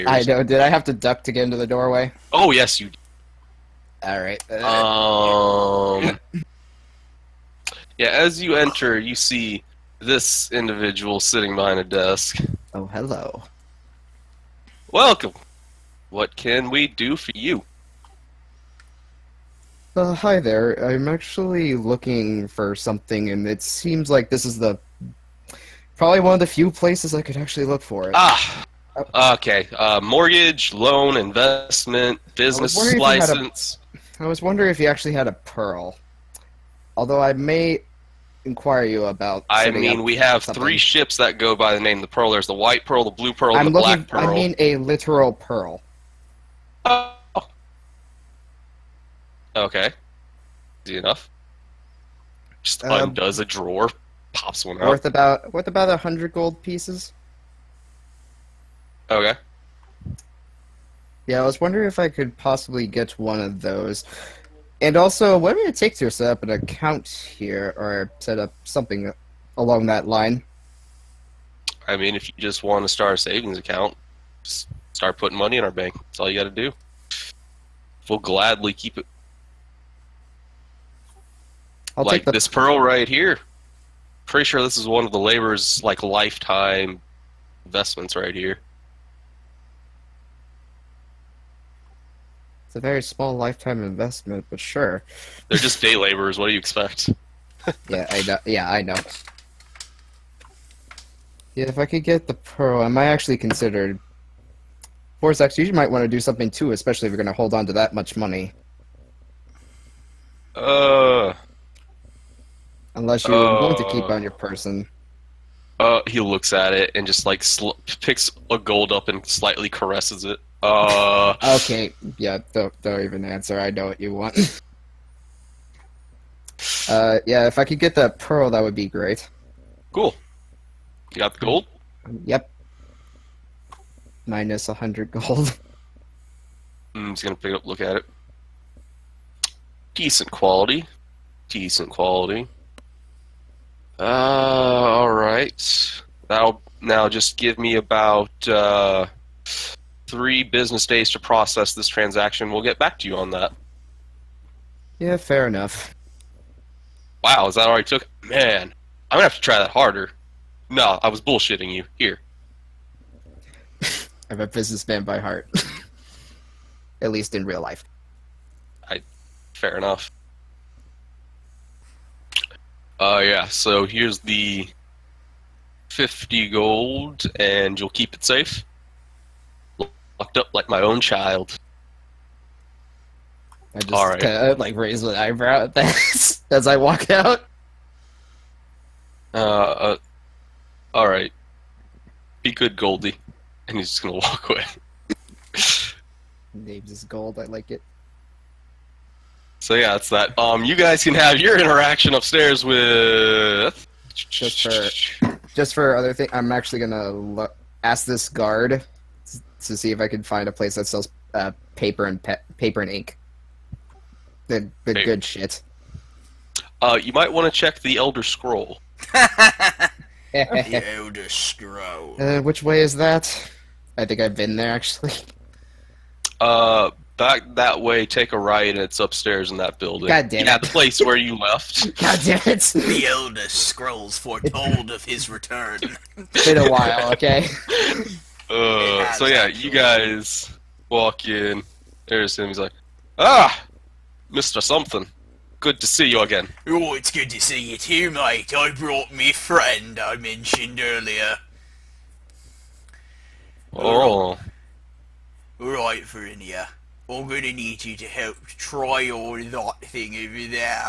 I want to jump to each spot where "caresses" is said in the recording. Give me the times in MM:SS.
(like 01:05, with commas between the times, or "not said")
01:59.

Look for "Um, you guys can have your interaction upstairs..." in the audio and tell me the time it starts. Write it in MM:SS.
03:20.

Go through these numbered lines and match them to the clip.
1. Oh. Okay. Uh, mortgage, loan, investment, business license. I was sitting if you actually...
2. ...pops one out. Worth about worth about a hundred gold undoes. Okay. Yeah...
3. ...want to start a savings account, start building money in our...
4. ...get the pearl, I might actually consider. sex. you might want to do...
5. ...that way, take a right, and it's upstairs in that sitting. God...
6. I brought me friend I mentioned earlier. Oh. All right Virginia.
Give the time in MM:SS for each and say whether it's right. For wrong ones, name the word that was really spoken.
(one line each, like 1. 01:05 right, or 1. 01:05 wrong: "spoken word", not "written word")
1. 00:29 wrong: "wondering", not "sitting"
2. 00:54 wrong: "pieces", not "undoes"
3. 01:12 wrong: "putting", not "building"
4. 01:42 right
5. 03:47 wrong: "building", not "sitting"
6. 04:08 right.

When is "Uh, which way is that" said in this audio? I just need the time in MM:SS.
03:42.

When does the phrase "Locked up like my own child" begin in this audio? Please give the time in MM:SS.
03:00.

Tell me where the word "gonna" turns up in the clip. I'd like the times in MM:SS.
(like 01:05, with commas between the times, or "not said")
02:17, 02:39, 03:14, 03:26, 04:17.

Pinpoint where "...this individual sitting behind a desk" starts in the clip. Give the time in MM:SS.
00:09.